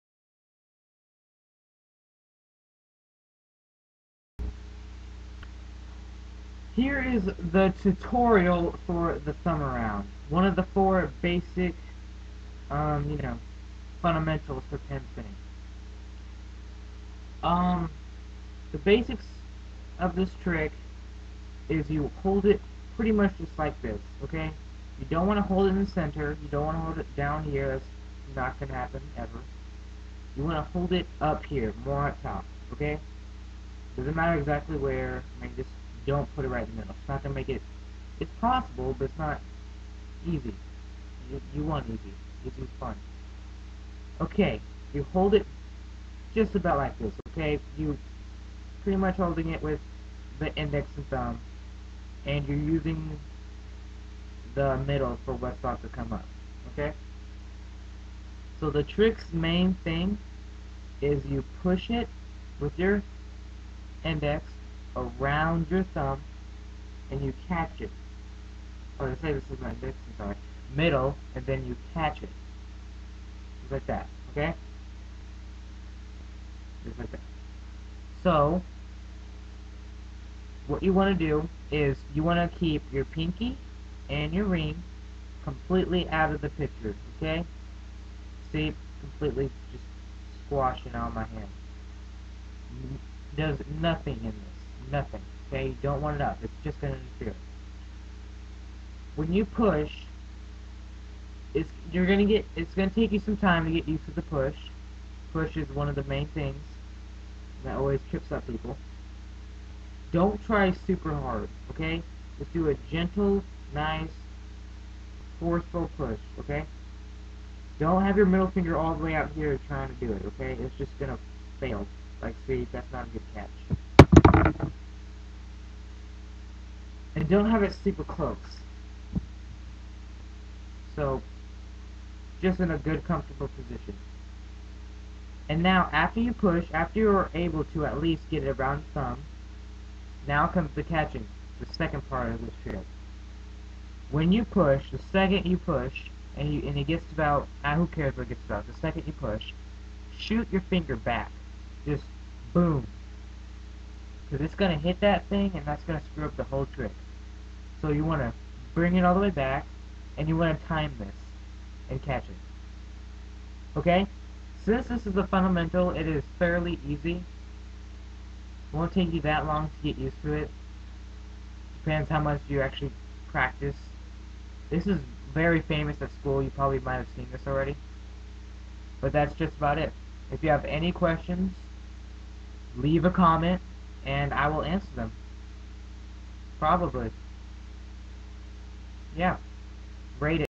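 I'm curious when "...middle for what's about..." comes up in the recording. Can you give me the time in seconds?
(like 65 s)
54 s.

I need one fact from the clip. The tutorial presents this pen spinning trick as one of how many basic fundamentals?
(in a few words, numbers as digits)
4.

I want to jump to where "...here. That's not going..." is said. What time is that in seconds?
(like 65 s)
27 s.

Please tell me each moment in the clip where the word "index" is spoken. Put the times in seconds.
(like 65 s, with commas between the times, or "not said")
50 s, 64 s.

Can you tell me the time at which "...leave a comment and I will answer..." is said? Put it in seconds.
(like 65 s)
182 s.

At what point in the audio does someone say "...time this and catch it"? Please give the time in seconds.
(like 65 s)
160 s.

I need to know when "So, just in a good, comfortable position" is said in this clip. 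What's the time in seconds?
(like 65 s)
130 s.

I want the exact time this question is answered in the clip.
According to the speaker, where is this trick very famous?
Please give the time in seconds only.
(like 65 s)
176 s.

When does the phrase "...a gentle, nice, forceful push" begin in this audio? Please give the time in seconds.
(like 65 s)
112 s.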